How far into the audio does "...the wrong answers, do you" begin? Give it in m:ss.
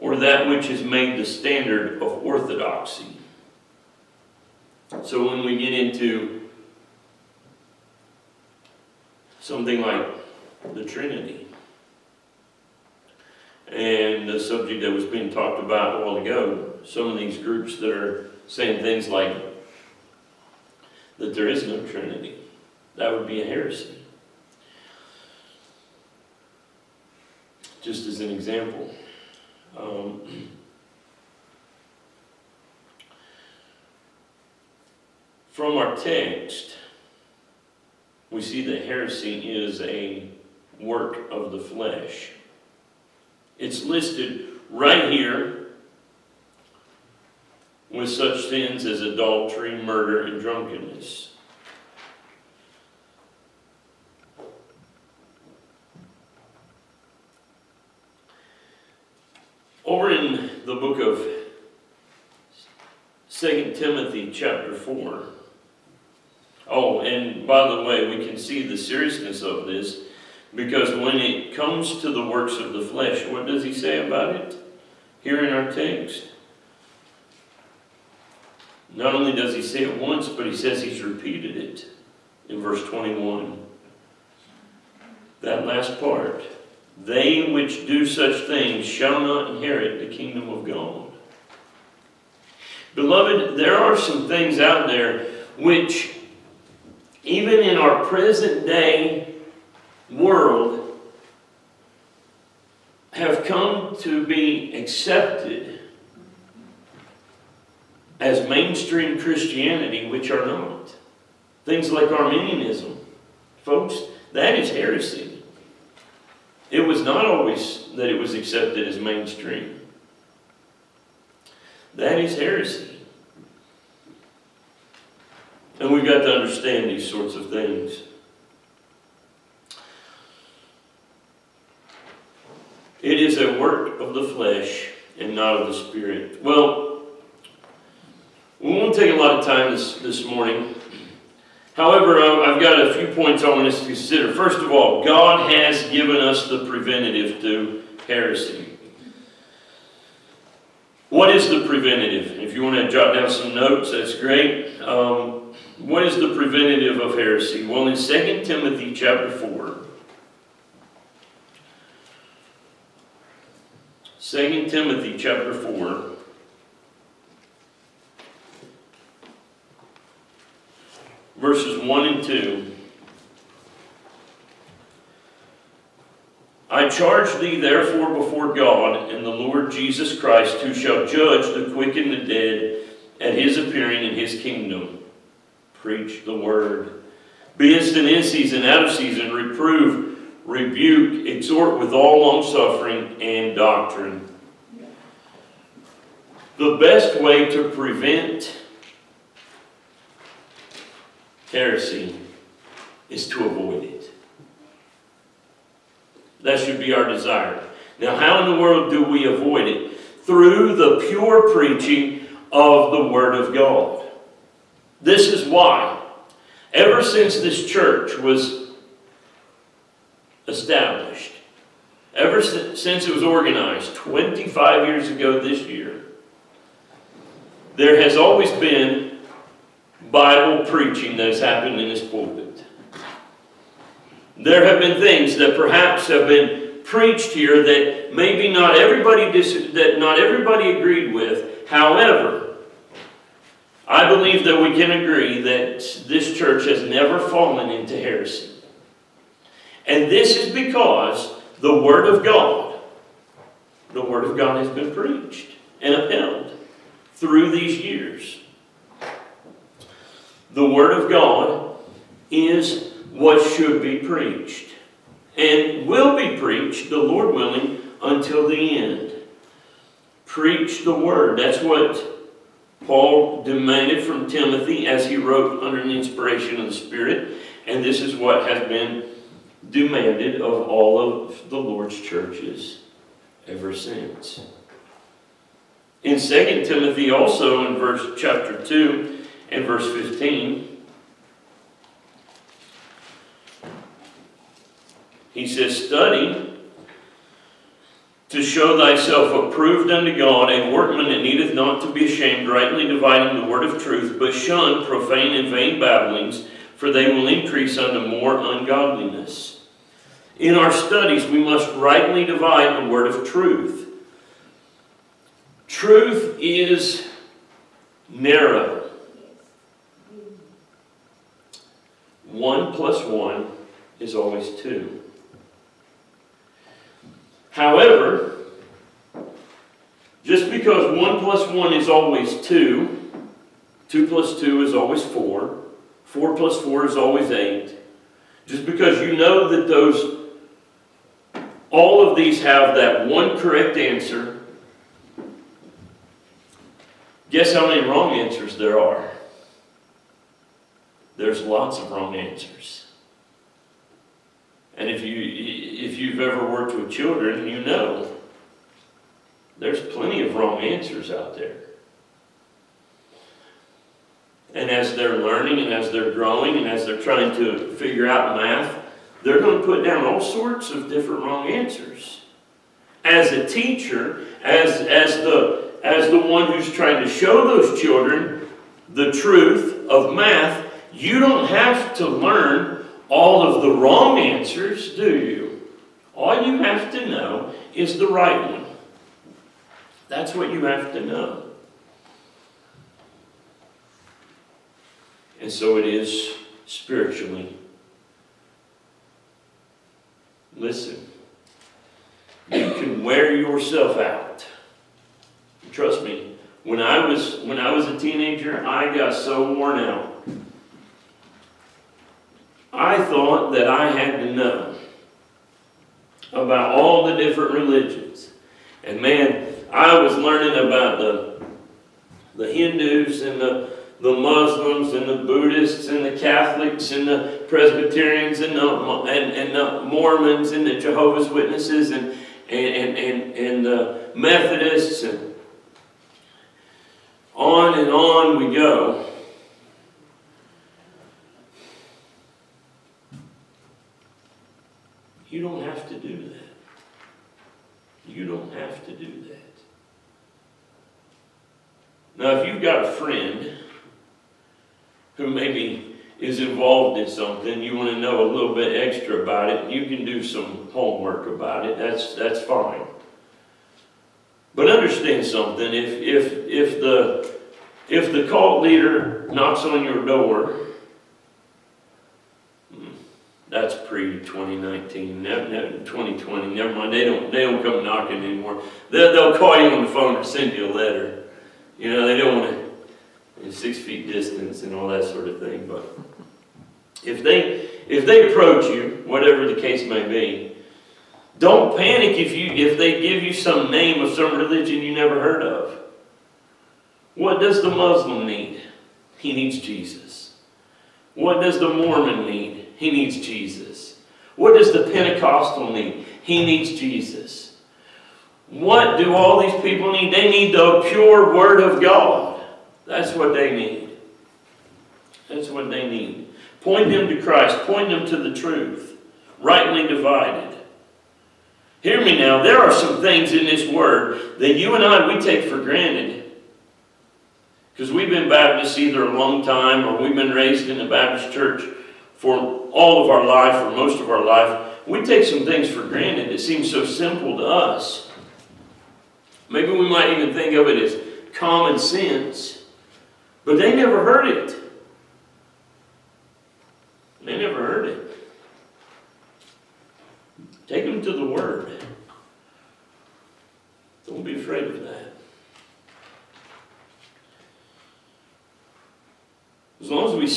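6:23.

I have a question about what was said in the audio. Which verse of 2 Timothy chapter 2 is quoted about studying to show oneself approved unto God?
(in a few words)
Verse 15.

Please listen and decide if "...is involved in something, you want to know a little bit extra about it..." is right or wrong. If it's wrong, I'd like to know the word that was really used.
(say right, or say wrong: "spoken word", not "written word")
right.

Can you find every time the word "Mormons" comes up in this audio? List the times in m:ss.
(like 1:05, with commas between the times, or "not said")
7:09, 8:21.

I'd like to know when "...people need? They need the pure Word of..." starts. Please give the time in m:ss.
8:29.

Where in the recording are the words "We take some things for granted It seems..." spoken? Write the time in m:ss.
8:54.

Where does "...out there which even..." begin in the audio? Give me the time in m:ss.
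1:34.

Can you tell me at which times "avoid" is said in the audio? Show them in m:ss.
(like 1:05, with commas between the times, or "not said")
3:23, 3:29.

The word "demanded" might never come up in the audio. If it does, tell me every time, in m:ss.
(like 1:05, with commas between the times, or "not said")
4:33, 4:39.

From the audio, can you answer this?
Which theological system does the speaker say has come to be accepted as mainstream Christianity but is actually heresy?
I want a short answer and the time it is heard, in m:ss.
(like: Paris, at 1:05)
Arminianism, at 1:52.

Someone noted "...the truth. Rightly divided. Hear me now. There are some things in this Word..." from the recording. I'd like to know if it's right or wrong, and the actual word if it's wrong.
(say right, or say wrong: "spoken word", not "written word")
right.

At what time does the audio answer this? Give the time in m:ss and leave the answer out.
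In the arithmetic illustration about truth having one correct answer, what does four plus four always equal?
5:37.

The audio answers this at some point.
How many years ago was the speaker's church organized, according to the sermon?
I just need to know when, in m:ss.
3:43.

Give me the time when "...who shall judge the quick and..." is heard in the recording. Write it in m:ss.
3:00.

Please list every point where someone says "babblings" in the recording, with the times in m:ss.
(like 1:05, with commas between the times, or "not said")
5:05.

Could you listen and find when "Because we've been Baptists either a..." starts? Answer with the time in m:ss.
8:47.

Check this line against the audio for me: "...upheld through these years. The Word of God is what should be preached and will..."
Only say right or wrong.
right.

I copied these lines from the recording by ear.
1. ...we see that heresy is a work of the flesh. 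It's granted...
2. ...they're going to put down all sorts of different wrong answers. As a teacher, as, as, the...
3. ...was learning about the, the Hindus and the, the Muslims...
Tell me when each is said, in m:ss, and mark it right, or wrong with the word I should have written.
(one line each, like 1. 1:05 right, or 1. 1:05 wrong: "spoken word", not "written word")
1. 0:38 wrong: "listed", not "granted"
2. 6:09 right
3. 6:59 right.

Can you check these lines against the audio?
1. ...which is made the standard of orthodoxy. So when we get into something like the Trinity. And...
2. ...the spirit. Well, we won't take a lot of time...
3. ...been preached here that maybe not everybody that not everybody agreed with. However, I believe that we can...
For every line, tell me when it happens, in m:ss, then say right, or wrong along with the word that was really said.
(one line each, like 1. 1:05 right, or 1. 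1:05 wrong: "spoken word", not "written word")
1. 0:00 right
2. 2:15 right
3. 3:56 right.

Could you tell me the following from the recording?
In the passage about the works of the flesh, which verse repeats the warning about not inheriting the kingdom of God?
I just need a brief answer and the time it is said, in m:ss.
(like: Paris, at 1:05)
Verse 21, at 1:22.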